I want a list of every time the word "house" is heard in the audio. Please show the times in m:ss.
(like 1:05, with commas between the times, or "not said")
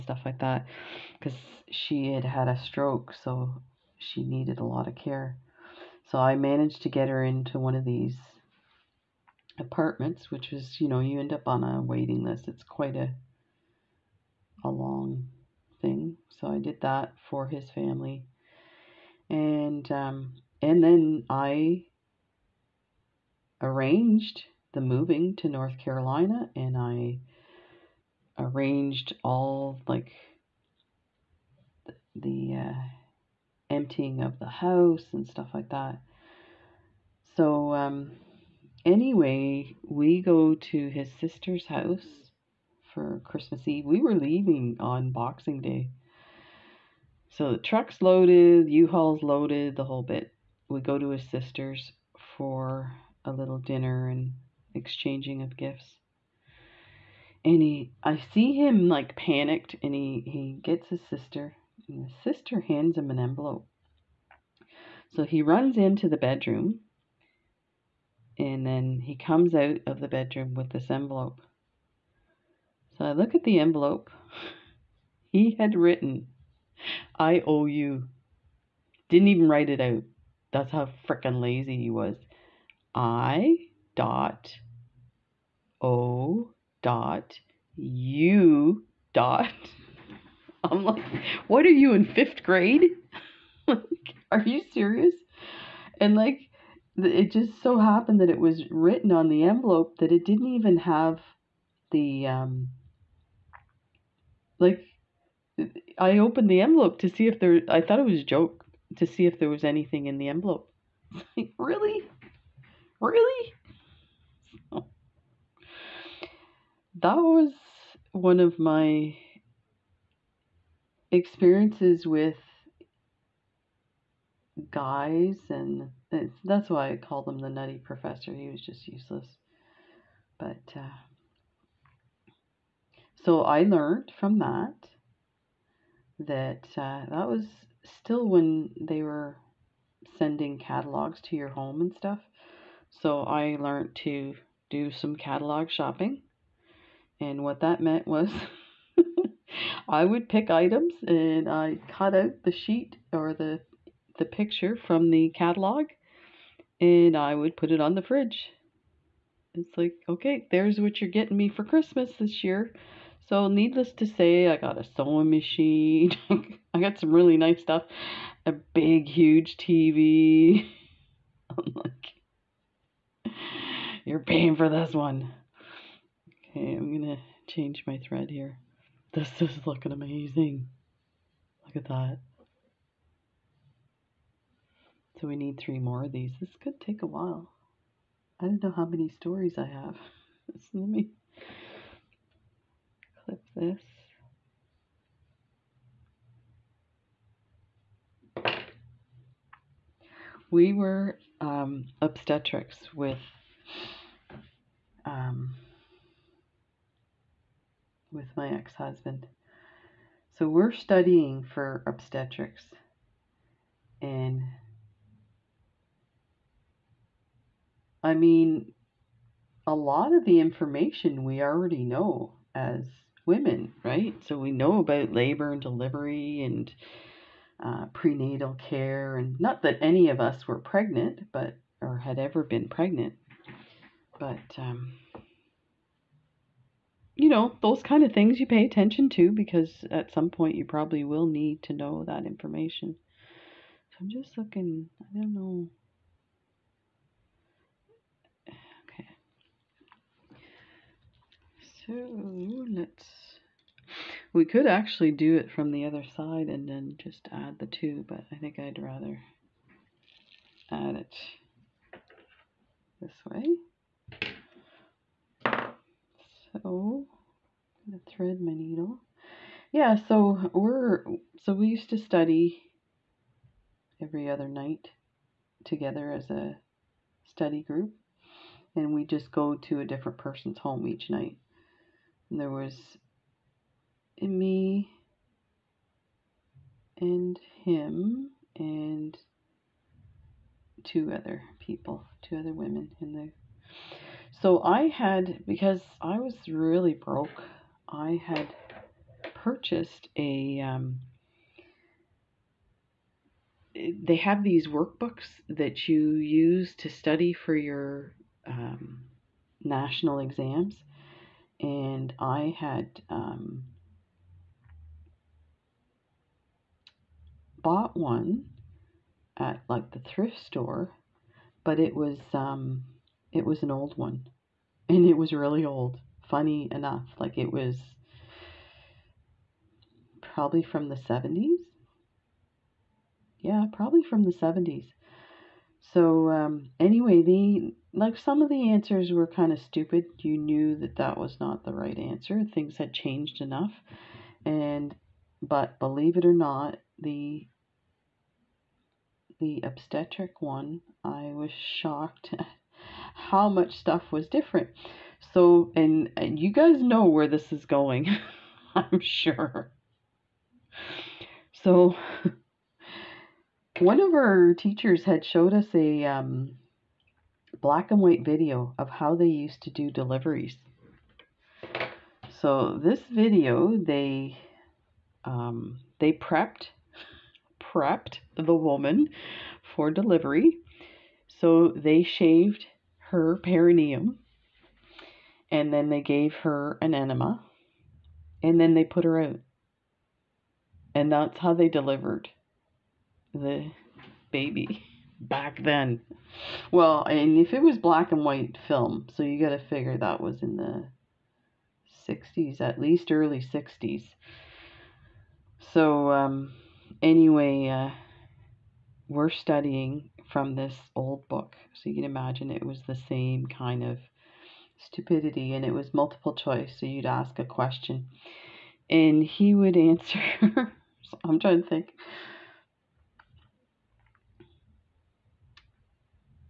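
0:34, 0:41.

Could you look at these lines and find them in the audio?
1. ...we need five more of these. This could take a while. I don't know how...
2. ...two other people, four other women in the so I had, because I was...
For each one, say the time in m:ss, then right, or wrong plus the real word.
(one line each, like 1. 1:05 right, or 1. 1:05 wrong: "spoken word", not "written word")
1. 3:05 wrong: "three", not "five"
2. 4:50 wrong: "two", not "four".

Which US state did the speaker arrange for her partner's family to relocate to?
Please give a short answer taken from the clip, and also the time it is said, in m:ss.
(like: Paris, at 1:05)
North Carolina, at 0:25.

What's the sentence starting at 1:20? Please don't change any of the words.
That's how frickin' lazy he was.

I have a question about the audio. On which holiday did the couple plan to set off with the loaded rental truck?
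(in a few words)
Boxing Day.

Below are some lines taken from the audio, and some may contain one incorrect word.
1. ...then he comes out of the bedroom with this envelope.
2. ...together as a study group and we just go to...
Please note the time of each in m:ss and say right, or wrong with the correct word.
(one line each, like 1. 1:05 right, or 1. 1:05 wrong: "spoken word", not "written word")
1. 1:08 right
2. 4:35 right.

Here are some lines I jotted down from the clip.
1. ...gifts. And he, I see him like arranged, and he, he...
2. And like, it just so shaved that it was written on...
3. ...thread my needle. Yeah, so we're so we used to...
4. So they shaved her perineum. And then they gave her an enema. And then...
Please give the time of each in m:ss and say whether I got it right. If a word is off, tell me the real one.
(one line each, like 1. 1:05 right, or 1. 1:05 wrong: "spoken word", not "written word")
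1. 0:55 wrong: "panicked", not "arranged"
2. 1:35 wrong: "happened", not "shaved"
3. 4:28 right
4. 6:21 right.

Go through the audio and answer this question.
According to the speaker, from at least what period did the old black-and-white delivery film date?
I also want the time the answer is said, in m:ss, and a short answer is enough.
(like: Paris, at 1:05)
early 1960s, at 6:43.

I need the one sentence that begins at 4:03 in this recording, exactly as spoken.
So I'm just looking, I don't know.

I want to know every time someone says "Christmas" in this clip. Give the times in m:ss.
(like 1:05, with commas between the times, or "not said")
0:43, 2:41.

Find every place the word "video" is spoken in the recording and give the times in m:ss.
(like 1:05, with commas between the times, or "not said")
6:08, 6:13.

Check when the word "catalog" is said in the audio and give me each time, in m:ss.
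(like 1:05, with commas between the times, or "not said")
2:20, 2:25, 2:35.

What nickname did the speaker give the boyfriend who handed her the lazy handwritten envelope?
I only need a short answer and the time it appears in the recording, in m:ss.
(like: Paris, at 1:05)
the nutty professor, at 2:07.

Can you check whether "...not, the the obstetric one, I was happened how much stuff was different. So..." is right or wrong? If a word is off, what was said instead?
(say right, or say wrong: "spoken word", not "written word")
wrong: "shocked", not "happened".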